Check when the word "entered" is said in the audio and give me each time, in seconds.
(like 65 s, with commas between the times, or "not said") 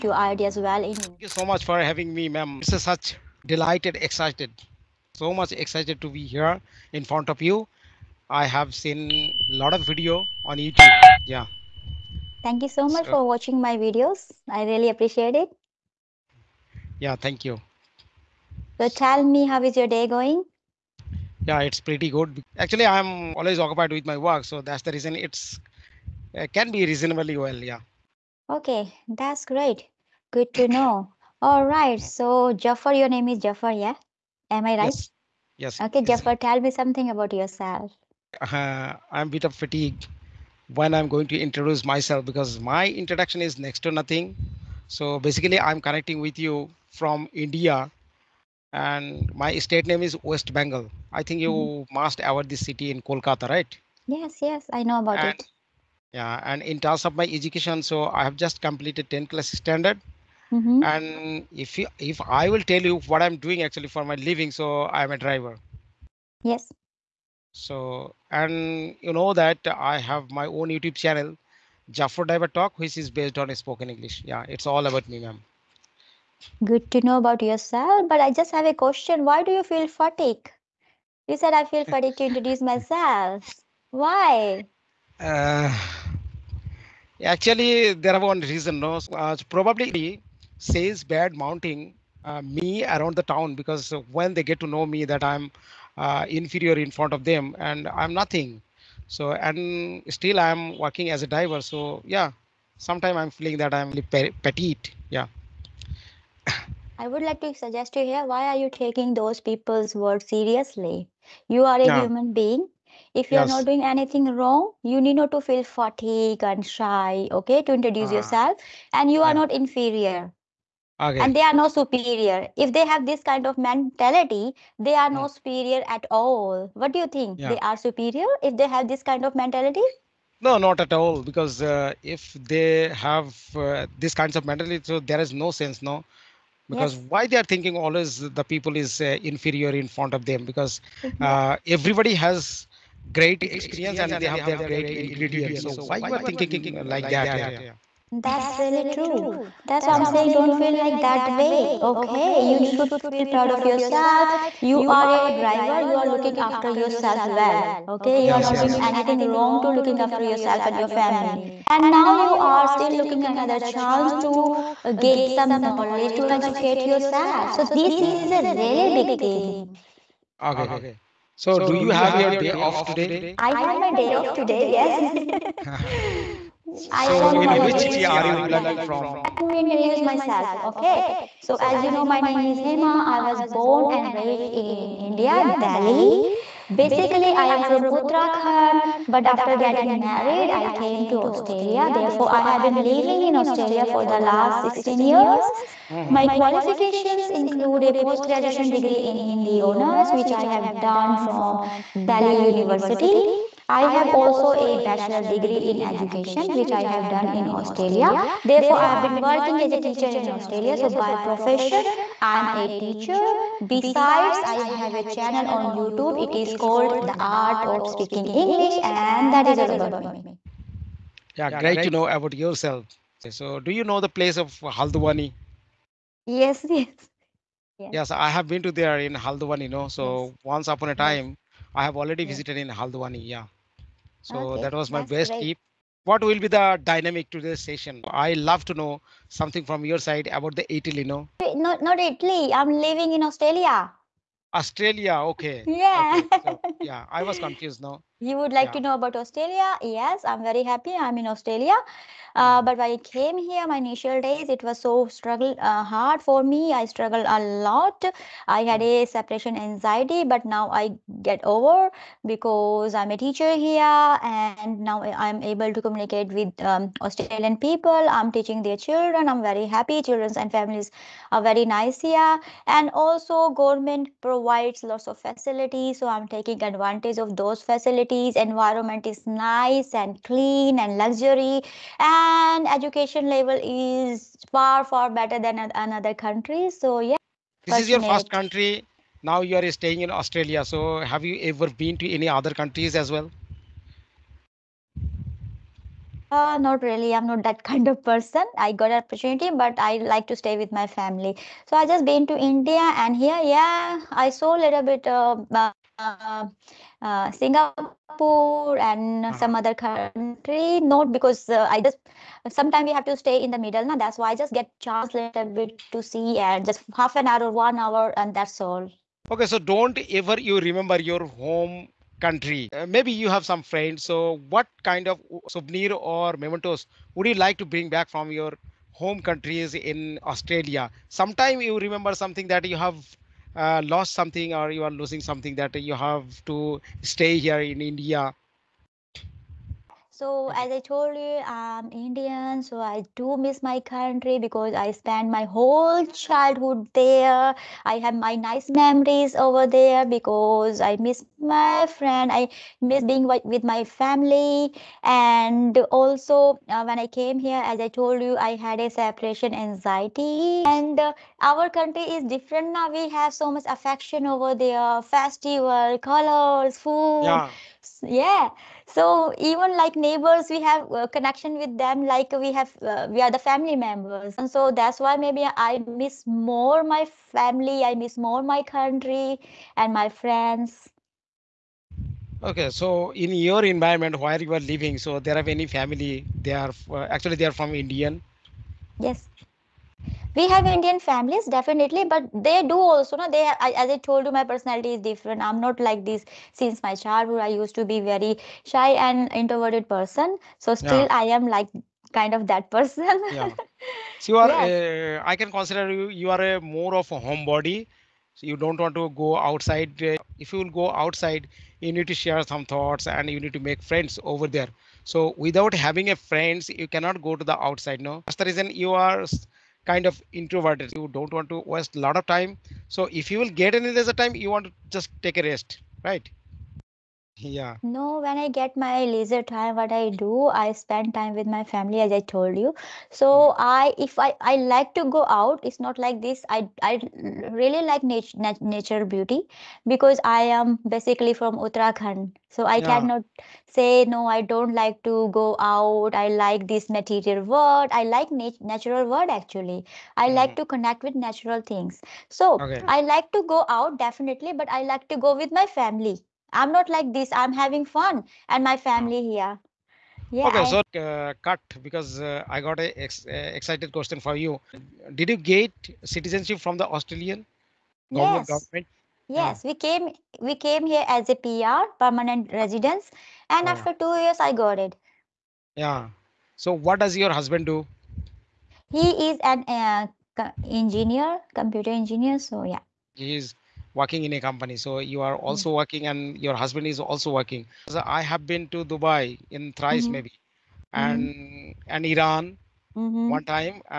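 not said.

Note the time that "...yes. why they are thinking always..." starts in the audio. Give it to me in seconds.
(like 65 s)
136 s.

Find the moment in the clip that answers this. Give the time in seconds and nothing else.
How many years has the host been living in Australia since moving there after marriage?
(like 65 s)
194 s.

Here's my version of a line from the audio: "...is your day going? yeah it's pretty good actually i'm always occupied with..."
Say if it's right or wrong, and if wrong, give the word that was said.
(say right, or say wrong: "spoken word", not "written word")
right.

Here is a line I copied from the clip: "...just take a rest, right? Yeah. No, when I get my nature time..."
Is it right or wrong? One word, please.
wrong.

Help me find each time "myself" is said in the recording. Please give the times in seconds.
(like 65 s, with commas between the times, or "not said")
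41 s, 82 s, 180 s.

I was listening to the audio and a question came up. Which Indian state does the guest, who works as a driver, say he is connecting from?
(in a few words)
West Bengal.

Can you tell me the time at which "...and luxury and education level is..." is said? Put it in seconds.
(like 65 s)
280 s.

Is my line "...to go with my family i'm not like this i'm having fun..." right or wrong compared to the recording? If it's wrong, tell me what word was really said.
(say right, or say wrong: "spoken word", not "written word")
right.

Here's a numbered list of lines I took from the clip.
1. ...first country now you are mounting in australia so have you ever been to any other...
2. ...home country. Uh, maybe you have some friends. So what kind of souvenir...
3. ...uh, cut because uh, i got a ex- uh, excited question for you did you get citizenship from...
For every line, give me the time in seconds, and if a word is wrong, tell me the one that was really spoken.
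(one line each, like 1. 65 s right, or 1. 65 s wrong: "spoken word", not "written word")
1. 288 s wrong: "staying", not "mounting"
2. 321 s right
3. 461 s right.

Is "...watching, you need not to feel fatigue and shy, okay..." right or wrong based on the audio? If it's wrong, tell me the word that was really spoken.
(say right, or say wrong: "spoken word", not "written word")
wrong: "wrong", not "watching".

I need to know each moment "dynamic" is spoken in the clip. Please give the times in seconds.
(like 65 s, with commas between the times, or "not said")
236 s.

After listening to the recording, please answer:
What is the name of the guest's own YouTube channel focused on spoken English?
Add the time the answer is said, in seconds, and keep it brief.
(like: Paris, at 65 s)
Jafar Driver Talk, at 71 s.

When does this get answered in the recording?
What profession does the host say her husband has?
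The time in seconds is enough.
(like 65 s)
481 s.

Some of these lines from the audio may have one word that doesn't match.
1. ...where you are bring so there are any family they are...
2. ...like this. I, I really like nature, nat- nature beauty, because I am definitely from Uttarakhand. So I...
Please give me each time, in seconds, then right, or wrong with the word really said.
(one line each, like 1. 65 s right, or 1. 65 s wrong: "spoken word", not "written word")
1. 384 s wrong: "living", not "bring"
2. 435 s wrong: "basically", not "definitely".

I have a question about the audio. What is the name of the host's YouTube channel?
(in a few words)
The Art of Speaking English.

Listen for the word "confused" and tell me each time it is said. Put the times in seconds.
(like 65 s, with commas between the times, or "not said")
247 s.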